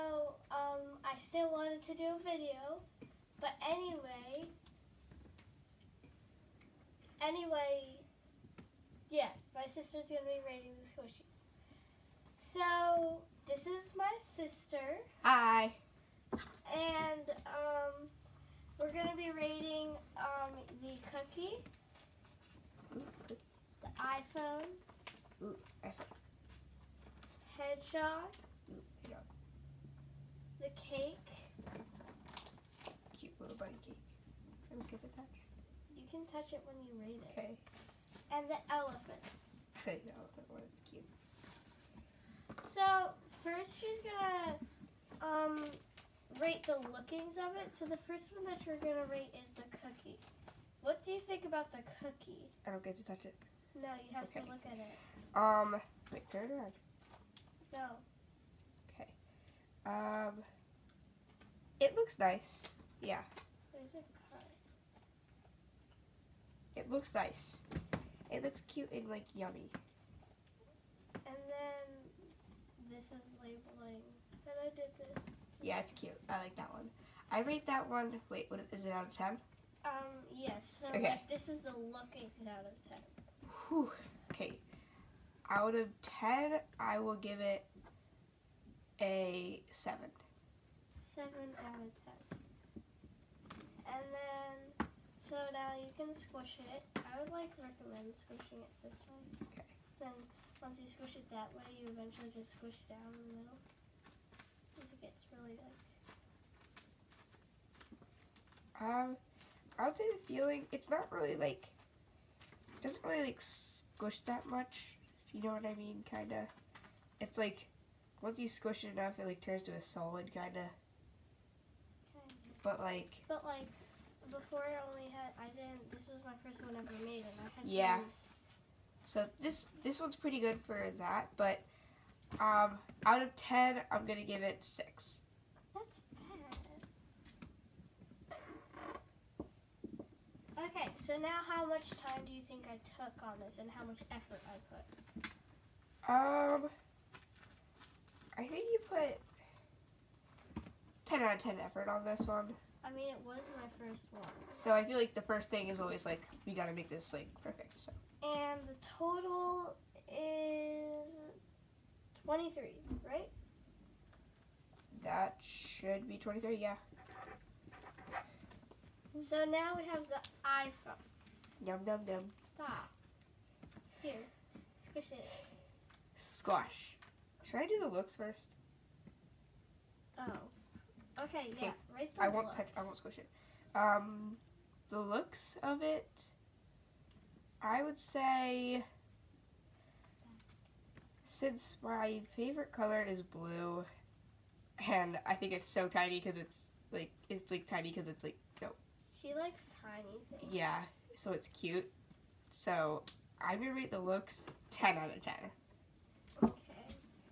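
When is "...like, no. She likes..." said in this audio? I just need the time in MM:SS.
03:18.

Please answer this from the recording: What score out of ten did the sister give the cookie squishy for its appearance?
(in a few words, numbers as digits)
7.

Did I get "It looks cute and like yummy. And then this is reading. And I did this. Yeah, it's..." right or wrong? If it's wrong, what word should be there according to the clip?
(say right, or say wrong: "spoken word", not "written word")
wrong: "labeling", not "reading".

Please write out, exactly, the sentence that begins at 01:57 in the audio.
It's like, once you squish it enough, it like turns to a solid, kinda.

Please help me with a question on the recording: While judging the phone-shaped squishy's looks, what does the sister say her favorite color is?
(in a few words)
Blue.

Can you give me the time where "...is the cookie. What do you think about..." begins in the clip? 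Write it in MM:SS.
00:49.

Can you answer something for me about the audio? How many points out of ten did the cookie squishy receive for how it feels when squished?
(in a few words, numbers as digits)
6.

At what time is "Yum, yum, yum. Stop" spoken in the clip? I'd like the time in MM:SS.
02:51.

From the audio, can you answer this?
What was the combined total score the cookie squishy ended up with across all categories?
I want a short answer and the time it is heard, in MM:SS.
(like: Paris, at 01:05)
23, at 02:38.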